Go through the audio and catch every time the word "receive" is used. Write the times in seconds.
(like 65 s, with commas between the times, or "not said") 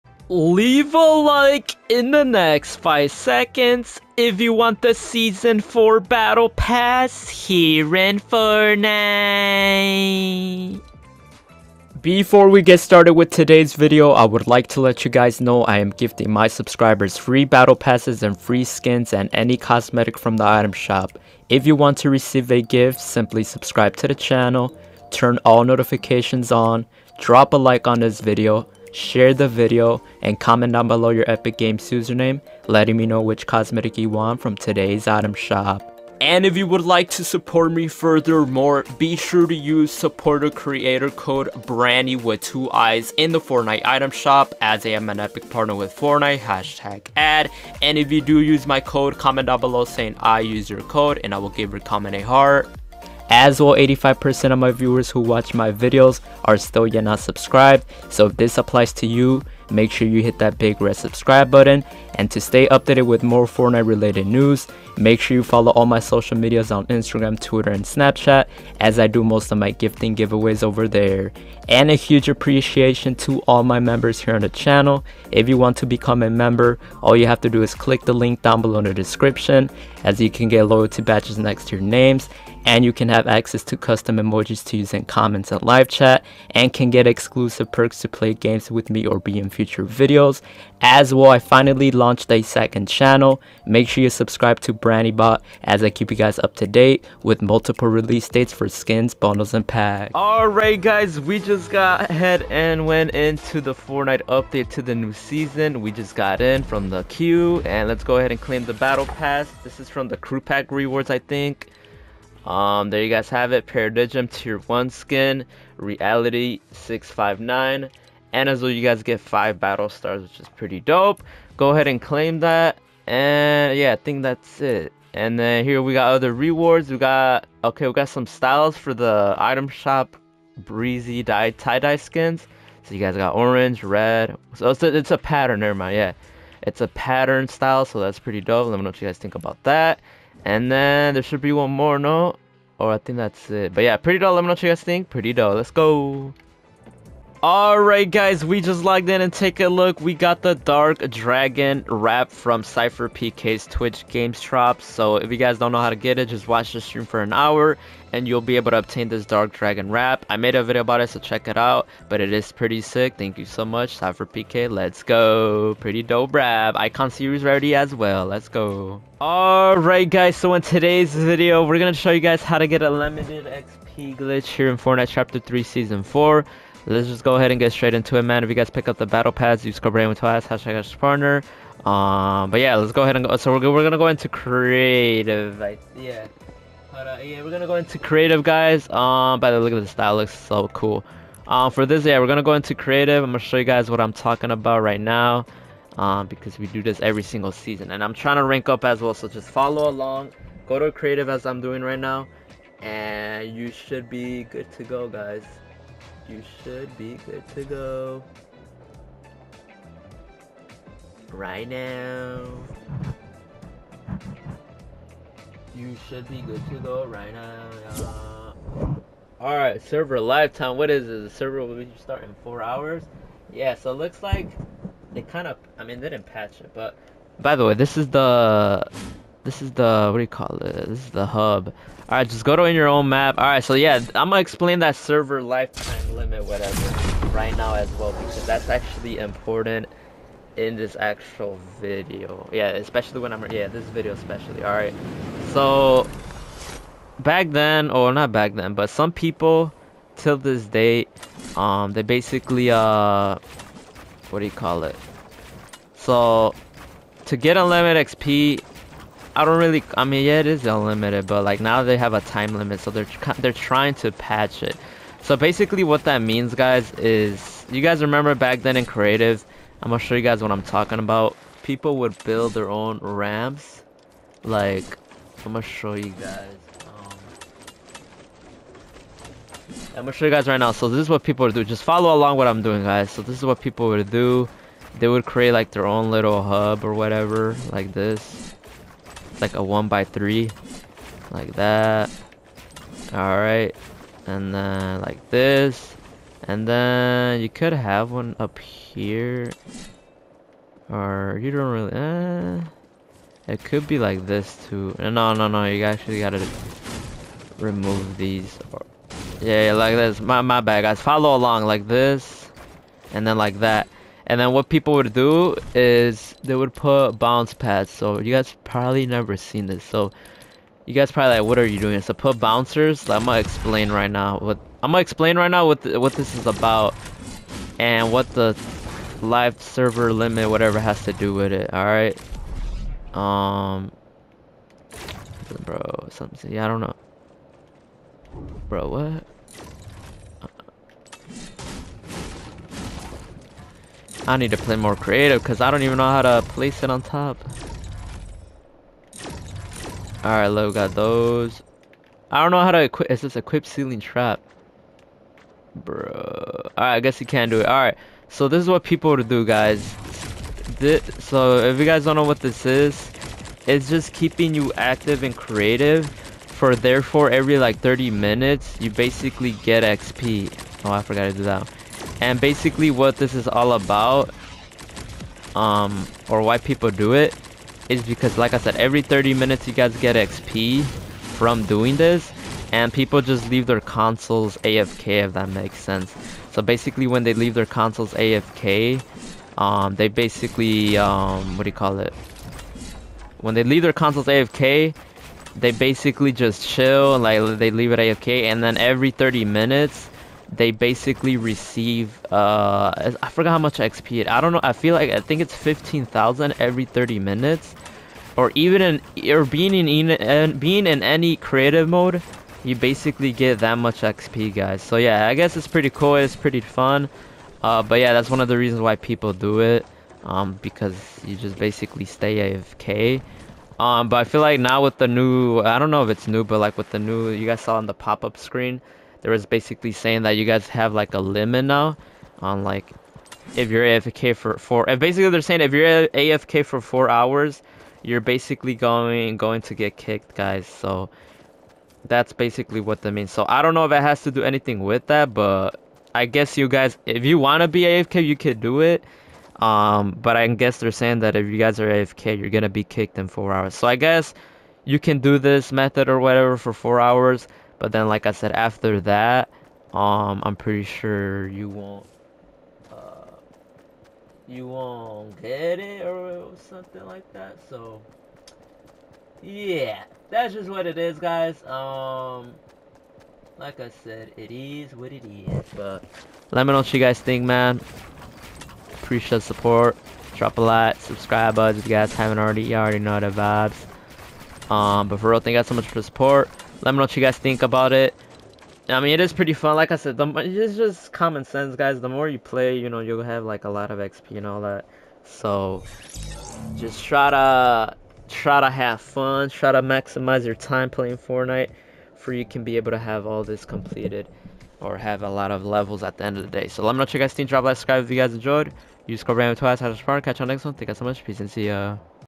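22 s, 401 s.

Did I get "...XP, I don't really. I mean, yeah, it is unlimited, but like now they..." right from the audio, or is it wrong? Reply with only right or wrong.
right.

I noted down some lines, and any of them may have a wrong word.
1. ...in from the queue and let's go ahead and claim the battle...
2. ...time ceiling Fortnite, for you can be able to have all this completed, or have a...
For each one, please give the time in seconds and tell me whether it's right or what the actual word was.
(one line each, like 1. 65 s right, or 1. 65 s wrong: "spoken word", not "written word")
1. 106 s right
2. 500 s wrong: "playing", not "ceiling".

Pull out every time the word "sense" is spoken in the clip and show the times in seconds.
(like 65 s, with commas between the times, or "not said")
385 s, 491 s.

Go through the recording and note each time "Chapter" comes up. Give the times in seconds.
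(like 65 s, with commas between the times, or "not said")
175 s.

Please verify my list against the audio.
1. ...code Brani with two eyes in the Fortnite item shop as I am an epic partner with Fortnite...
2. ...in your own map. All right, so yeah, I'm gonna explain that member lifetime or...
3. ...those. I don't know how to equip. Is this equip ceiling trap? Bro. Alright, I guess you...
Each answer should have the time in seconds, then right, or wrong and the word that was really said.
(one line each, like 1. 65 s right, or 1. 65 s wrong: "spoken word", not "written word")
1. 41 s right
2. 232 s wrong: "server", not "member"
3. 350 s right.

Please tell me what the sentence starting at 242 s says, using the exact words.
Yeah, especially when I'm yeah this video especially.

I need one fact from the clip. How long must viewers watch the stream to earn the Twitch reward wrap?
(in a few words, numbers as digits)
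an hour.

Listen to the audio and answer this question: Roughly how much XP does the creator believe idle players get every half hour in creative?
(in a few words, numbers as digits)
15,000.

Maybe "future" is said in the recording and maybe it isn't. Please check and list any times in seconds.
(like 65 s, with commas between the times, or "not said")
89 s.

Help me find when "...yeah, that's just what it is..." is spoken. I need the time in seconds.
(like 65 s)
469 s.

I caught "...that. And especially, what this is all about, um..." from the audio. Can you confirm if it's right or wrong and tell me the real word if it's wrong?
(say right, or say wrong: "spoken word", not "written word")
wrong: "basically", not "especially".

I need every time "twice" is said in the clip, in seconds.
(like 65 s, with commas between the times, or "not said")
180 s, 509 s.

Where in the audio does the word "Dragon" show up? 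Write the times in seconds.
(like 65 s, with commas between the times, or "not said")
151 s, 159 s.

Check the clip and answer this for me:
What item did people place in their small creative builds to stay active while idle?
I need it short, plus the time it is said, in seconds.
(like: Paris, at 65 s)
bounce pads, at 317 s.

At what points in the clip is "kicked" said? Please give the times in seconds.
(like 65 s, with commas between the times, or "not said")
439 s, 452 s.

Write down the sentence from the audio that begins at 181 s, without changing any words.
Um, but yeah, let's go ahead and go.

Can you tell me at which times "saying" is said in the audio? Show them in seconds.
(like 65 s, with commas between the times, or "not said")
49 s, 429 s, 435 s, 450 s.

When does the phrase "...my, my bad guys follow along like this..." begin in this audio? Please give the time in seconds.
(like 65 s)
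310 s.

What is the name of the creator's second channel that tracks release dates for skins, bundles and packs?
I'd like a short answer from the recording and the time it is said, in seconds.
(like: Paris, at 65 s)
BraniBot, at 94 s.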